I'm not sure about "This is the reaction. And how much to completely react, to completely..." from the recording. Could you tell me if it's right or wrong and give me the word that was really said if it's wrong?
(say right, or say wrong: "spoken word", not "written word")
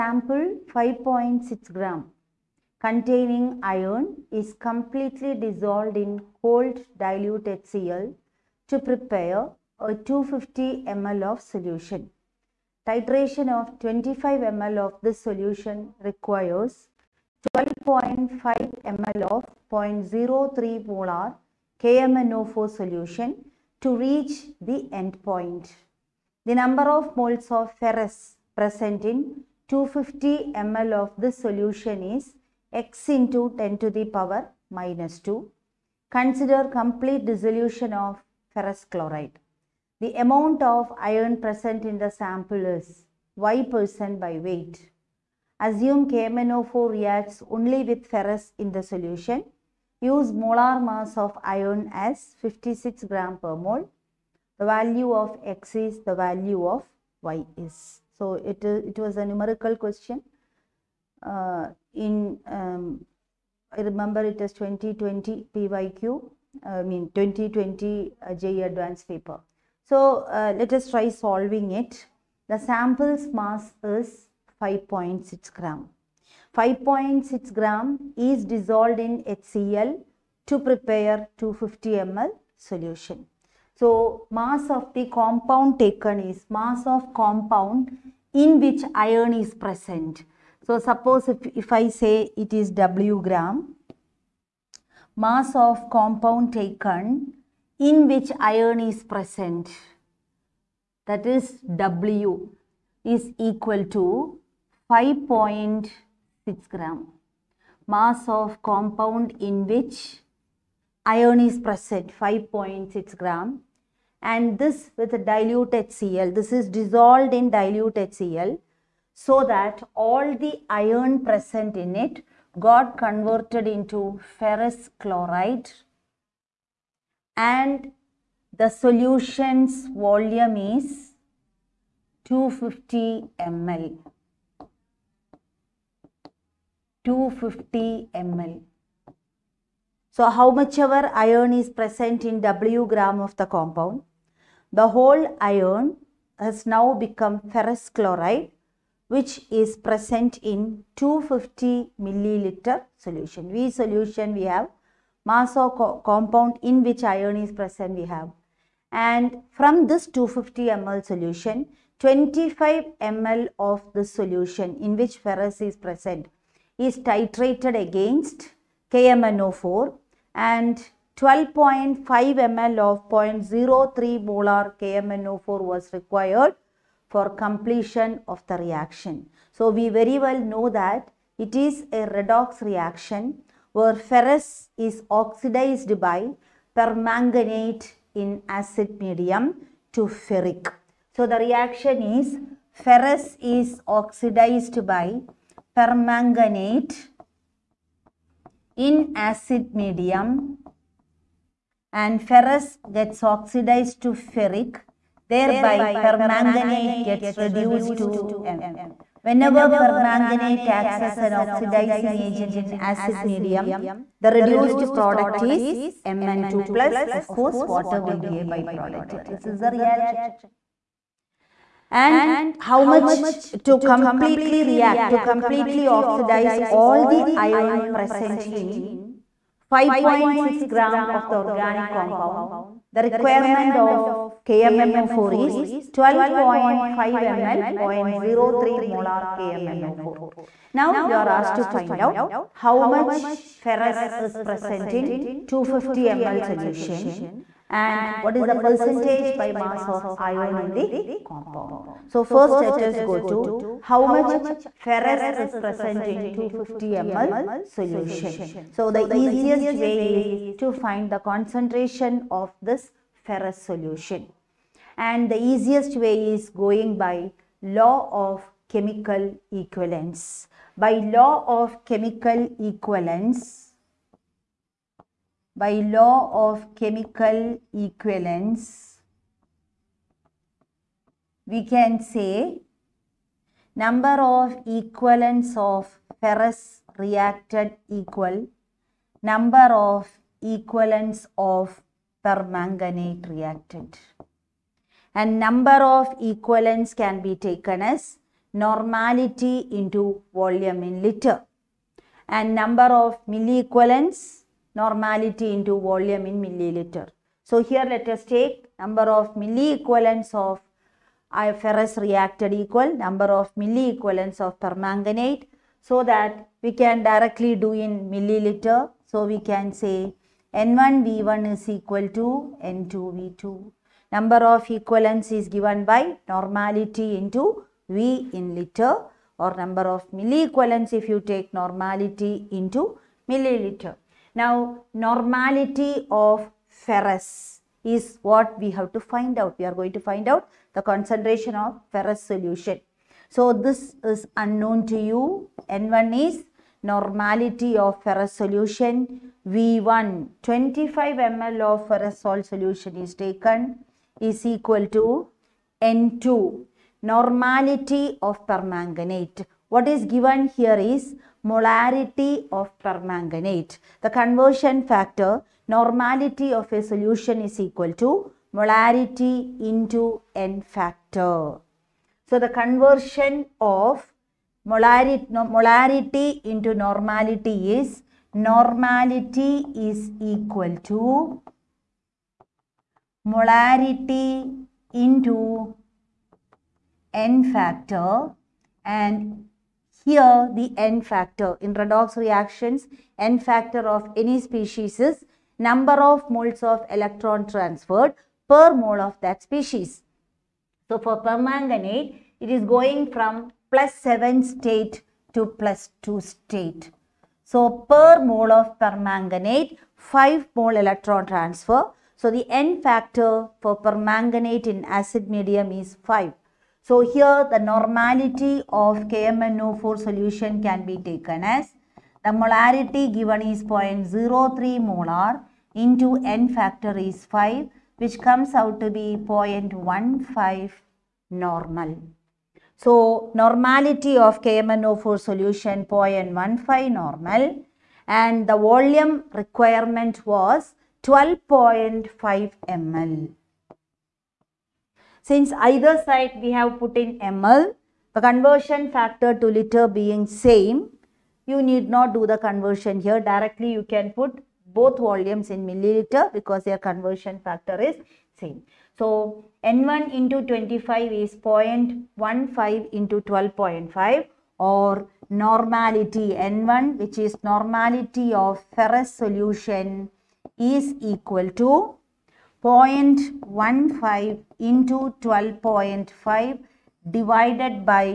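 right.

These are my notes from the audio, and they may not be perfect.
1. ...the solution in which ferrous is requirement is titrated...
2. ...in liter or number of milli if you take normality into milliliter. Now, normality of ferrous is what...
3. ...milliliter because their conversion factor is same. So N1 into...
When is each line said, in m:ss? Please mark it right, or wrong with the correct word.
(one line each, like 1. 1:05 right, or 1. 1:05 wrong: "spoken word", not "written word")
1. 2:43 wrong: "present", not "requirement"
2. 5:28 right
3. 7:35 right.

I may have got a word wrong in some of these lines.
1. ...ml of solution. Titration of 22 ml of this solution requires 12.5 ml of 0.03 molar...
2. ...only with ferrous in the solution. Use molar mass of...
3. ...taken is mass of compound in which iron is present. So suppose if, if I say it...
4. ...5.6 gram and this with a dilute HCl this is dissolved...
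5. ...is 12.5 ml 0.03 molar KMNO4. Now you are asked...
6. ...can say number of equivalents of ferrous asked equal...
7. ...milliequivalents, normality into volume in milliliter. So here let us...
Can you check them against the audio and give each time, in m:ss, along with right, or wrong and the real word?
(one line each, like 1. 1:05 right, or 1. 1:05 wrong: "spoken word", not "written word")
1. 0:11 wrong: "25", not "22"
2. 0:47 right
3. 1:25 right
4. 1:52 right
5. 3:55 right
6. 4:41 wrong: "reacted", not "asked"
7. 5:03 right.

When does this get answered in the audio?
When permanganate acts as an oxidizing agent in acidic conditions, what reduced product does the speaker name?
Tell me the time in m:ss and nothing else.
3:36.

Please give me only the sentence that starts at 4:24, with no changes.
And the easiest way is going by law of chemical equivalence.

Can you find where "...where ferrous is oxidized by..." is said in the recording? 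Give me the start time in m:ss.
3:03.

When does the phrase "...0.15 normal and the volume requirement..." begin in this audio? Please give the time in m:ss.
7:15.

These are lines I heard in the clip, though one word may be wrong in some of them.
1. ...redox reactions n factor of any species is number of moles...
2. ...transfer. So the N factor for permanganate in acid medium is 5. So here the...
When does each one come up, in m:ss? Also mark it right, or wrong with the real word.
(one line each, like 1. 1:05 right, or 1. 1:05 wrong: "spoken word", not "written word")
1. 6:31 right
2. 6:51 right.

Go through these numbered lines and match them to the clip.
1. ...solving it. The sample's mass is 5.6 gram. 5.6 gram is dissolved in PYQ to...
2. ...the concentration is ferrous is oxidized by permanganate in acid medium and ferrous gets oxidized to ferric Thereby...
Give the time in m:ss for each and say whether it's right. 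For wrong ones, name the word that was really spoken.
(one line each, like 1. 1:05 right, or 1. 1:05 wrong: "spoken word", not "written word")
1. 1:11 wrong: "HCl", not "PYQ"
2. 3:11 wrong: "reaction", not "concentration".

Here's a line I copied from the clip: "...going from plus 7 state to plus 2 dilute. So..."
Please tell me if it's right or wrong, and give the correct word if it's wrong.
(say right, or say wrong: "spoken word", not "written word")
wrong: "state", not "dilute".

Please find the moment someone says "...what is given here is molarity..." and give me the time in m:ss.
5:59.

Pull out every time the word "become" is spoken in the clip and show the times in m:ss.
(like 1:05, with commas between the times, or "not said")
2:26.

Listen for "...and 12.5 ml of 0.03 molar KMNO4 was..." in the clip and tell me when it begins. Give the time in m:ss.
2:50.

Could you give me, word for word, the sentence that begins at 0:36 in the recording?
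Consider complete dissolution of ferrous chloride.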